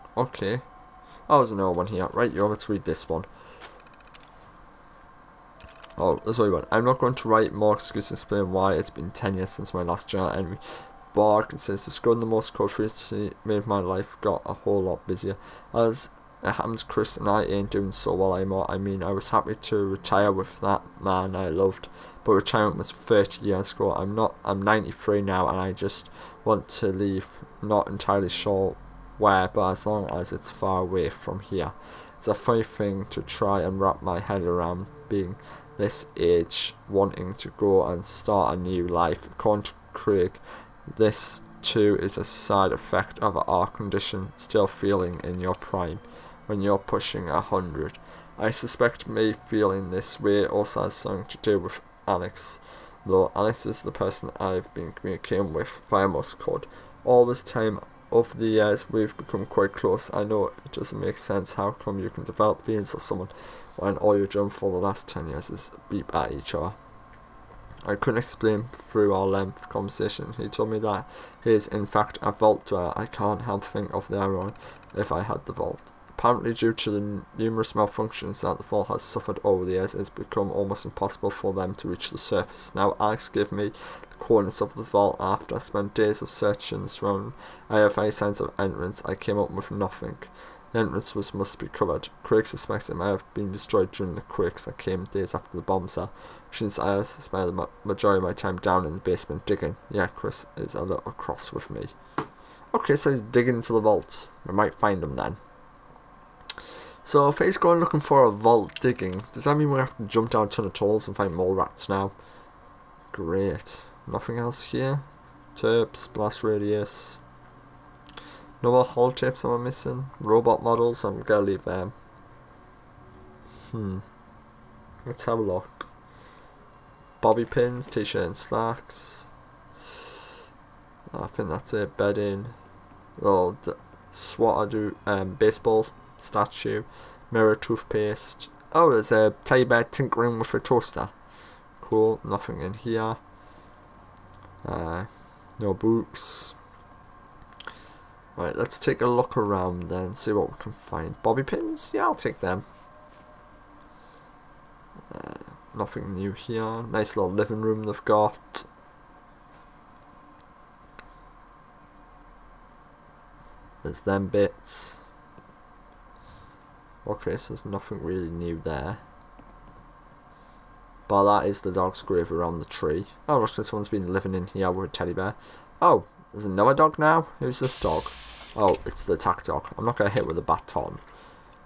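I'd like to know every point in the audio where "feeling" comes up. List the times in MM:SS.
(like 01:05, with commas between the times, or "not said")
00:44, 00:49, 01:02.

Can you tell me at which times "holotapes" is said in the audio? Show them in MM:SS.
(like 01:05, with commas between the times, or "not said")
01:58.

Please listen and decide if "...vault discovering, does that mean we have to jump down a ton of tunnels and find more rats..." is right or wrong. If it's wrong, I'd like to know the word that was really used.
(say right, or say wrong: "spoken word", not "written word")
wrong: "digging", not "discovering".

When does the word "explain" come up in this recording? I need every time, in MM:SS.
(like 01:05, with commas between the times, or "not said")
00:08, 01:08.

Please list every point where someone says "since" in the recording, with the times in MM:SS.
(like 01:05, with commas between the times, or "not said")
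00:09, 01:36.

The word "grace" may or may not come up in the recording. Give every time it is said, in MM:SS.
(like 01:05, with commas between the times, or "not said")
not said.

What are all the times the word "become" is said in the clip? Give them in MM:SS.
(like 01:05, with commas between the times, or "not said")
00:59, 01:20.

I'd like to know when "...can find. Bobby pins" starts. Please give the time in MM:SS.
02:30.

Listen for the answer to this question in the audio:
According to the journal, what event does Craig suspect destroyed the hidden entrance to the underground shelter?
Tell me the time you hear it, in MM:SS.
01:34.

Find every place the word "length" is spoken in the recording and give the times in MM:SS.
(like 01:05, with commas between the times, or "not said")
01:09.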